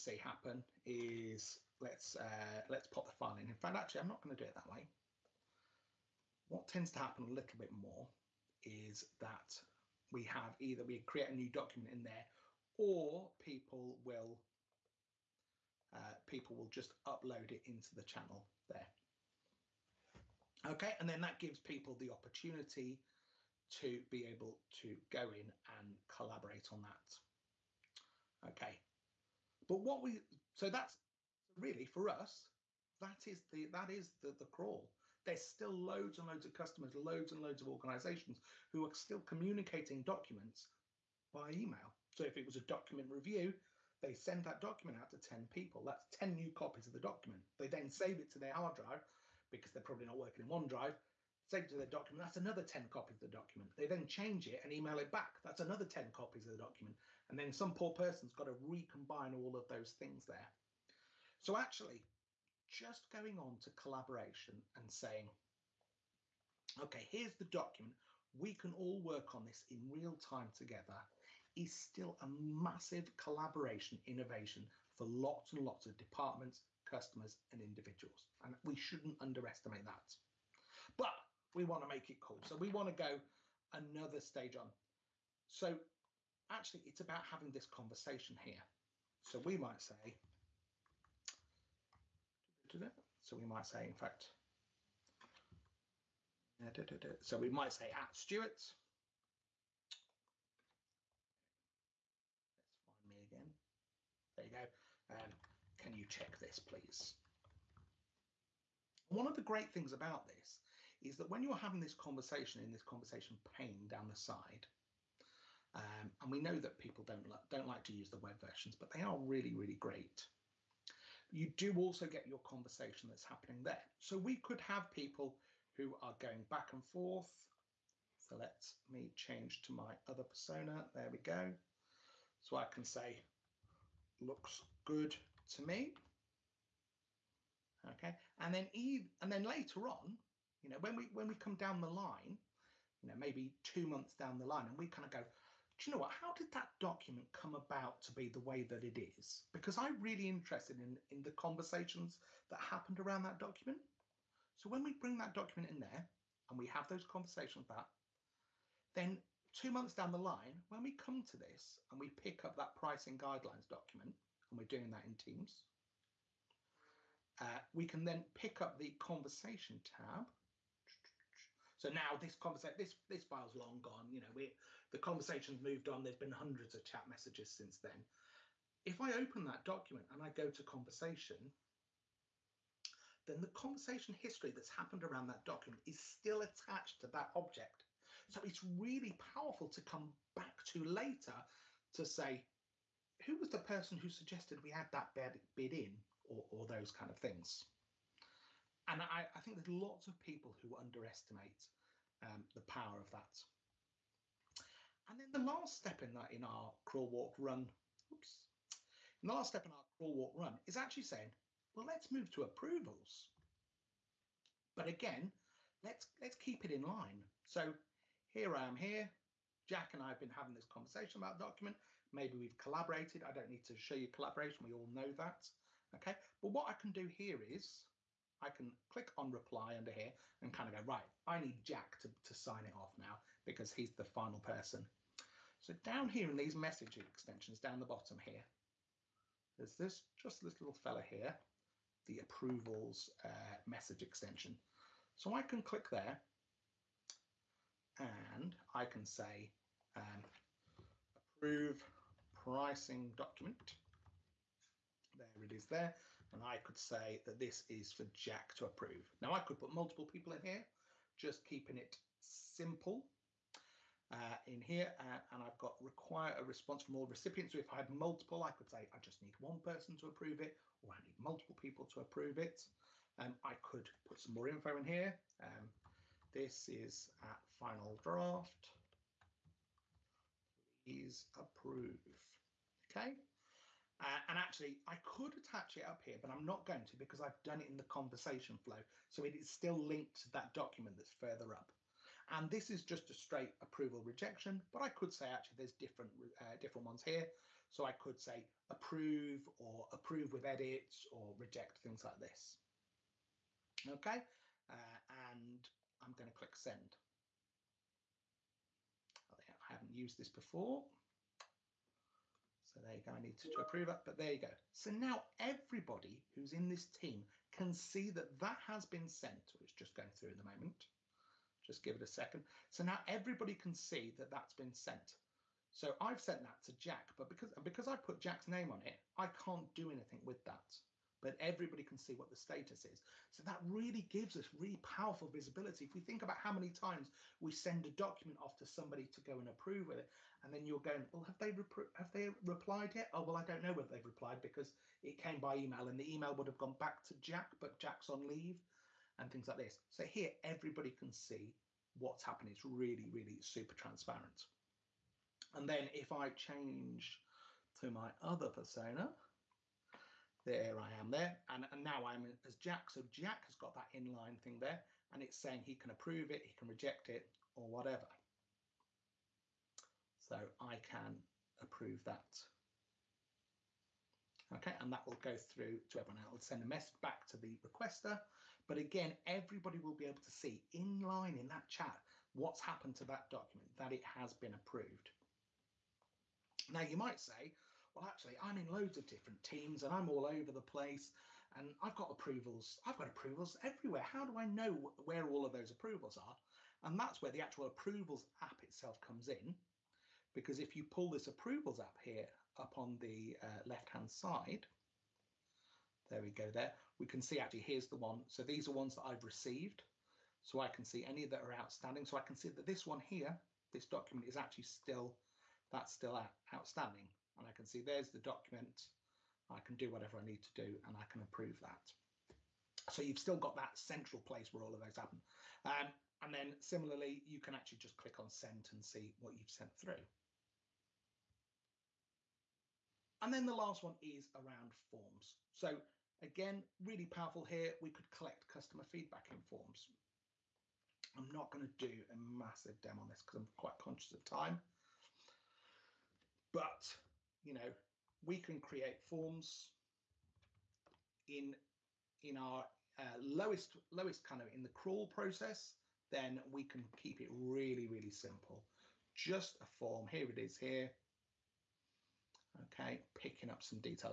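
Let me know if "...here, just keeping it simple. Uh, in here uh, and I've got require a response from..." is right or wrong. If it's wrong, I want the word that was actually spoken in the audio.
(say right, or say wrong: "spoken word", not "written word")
right.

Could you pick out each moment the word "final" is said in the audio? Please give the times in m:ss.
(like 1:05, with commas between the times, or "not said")
3:54, 4:37.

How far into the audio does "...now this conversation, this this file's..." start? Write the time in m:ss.
2:51.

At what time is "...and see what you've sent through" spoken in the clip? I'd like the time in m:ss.
7:08.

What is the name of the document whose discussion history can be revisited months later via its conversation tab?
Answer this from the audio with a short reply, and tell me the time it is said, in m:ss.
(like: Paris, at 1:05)
pricing guidelines, at 2:42.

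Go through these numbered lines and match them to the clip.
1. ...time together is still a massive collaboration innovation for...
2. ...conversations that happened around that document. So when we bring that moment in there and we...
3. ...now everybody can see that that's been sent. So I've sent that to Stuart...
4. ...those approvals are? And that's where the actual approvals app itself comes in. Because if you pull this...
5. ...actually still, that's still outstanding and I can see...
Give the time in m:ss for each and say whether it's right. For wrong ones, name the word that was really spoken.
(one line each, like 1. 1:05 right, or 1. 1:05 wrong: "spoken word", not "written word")
1. 1:10 right
2. 2:31 wrong: "document", not "moment"
3. 5:22 wrong: "Jack", not "Stuart"
4. 6:35 right
5. 6:54 right.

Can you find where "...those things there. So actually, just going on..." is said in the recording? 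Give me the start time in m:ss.
0:59.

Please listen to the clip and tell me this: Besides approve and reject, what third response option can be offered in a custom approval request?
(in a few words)
Approve with edits.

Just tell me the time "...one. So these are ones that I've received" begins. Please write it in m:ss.
6:47.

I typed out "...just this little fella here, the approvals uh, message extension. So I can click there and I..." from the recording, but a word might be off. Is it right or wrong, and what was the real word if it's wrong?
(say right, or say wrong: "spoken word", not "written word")
right.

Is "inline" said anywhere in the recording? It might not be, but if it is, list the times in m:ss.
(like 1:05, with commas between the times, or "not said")
6:03, 6:20.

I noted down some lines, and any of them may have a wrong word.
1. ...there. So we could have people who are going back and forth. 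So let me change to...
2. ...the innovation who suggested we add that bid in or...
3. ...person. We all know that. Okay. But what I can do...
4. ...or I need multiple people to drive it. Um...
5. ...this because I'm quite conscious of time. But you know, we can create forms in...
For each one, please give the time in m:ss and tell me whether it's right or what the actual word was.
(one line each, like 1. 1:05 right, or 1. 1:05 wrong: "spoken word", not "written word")
1. 2:03 right
2. 3:13 wrong: "person", not "innovation"
3. 3:44 wrong: "collaboration", not "person"
4. 4:30 wrong: "approve", not "drive"
5. 7:23 right.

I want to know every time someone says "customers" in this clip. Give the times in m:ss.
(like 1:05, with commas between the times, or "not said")
0:36, 1:16, 7:18.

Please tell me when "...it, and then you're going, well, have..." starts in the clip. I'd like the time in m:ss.
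5:39.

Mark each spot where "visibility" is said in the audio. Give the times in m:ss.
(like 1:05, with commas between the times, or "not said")
5:35.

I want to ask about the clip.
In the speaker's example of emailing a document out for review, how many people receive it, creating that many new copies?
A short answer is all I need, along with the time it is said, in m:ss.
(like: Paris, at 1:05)
10, at 0:45.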